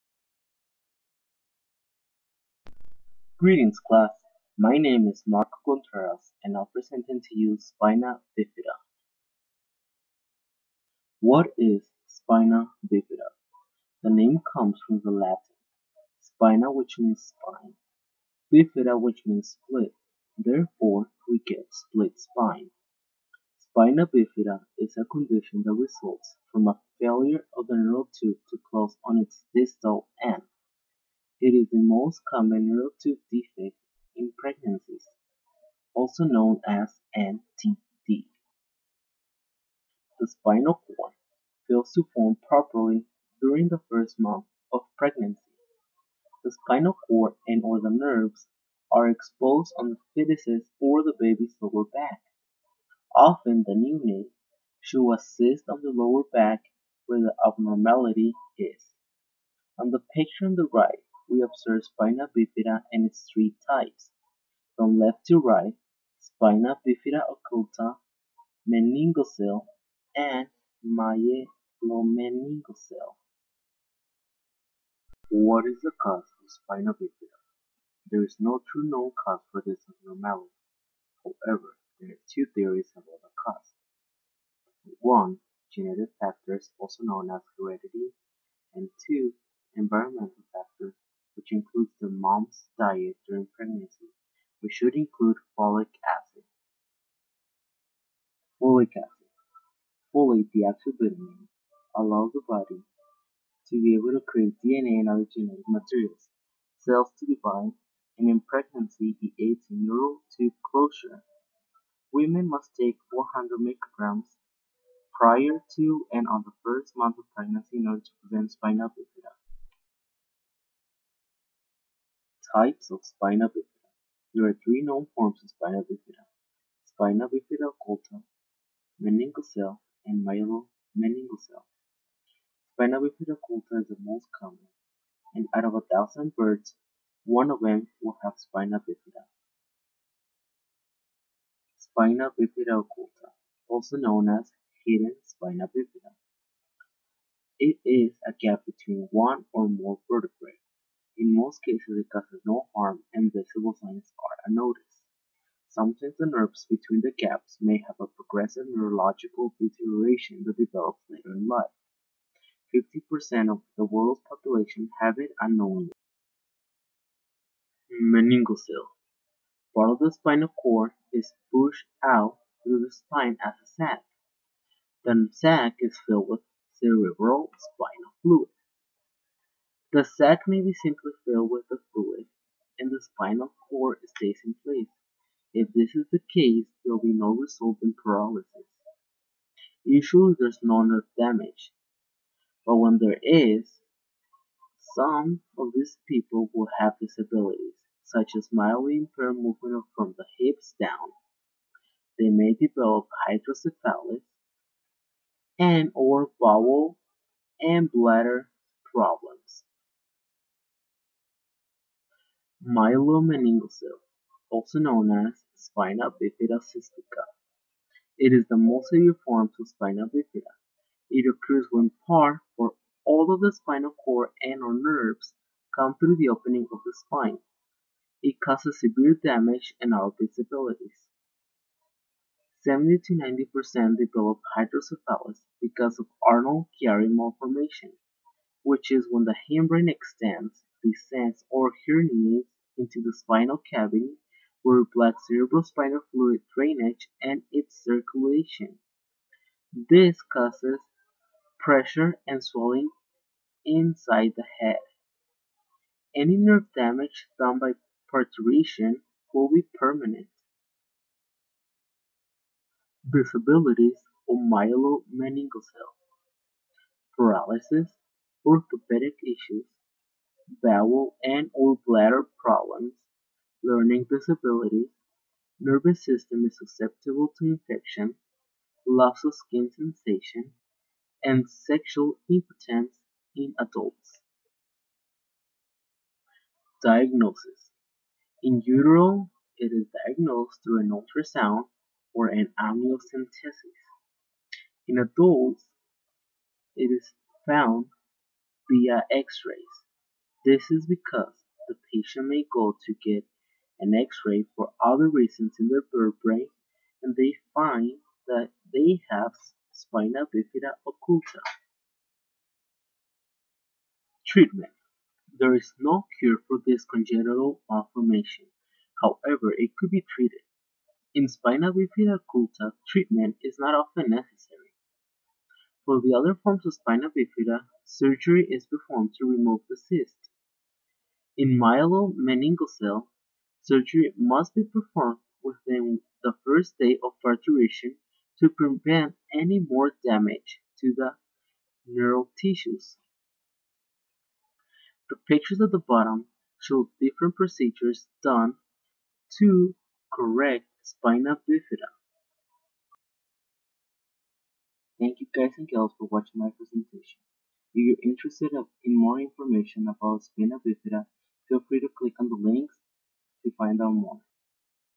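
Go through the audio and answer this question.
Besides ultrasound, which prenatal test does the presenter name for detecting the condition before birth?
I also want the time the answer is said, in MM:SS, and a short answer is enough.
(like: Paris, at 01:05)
Amniocentesis, at 04:52.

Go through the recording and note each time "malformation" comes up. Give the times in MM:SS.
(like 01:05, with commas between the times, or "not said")
03:57, 05:17.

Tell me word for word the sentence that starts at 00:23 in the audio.
Spina bifida is a condition that results from a failure of the neural tube to close on its distal end.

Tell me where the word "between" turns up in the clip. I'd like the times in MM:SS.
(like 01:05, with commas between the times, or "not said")
02:28, 02:36.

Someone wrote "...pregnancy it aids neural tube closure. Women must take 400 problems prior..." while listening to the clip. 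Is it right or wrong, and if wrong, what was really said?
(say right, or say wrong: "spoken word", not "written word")
wrong: "micrograms", not "problems".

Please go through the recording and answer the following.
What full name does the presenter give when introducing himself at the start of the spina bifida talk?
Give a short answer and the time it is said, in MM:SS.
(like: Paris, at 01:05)
Marco Contreras, at 00:05.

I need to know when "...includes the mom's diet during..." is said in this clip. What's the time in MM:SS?
01:31.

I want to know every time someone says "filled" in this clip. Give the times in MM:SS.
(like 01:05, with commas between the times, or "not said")
02:56, 03:01.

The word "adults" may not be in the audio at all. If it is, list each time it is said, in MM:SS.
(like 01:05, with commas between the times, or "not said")
04:43, 04:54.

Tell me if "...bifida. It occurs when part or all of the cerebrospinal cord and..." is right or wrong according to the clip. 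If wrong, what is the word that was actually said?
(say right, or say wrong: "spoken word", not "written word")
wrong: "spinal", not "cerebrospinal".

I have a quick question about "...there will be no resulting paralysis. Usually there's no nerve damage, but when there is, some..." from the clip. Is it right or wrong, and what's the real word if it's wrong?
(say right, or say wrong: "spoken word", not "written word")
right.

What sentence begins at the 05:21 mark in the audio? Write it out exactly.
In spina bifida occulta, treatment is not often necessary.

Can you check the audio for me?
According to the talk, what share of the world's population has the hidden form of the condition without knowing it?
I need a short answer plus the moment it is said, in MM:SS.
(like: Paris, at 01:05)
50%, at 02:42.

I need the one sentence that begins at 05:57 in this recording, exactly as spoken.
If you're interested in more information about spina bifida, Feel free to click on the links to find out more.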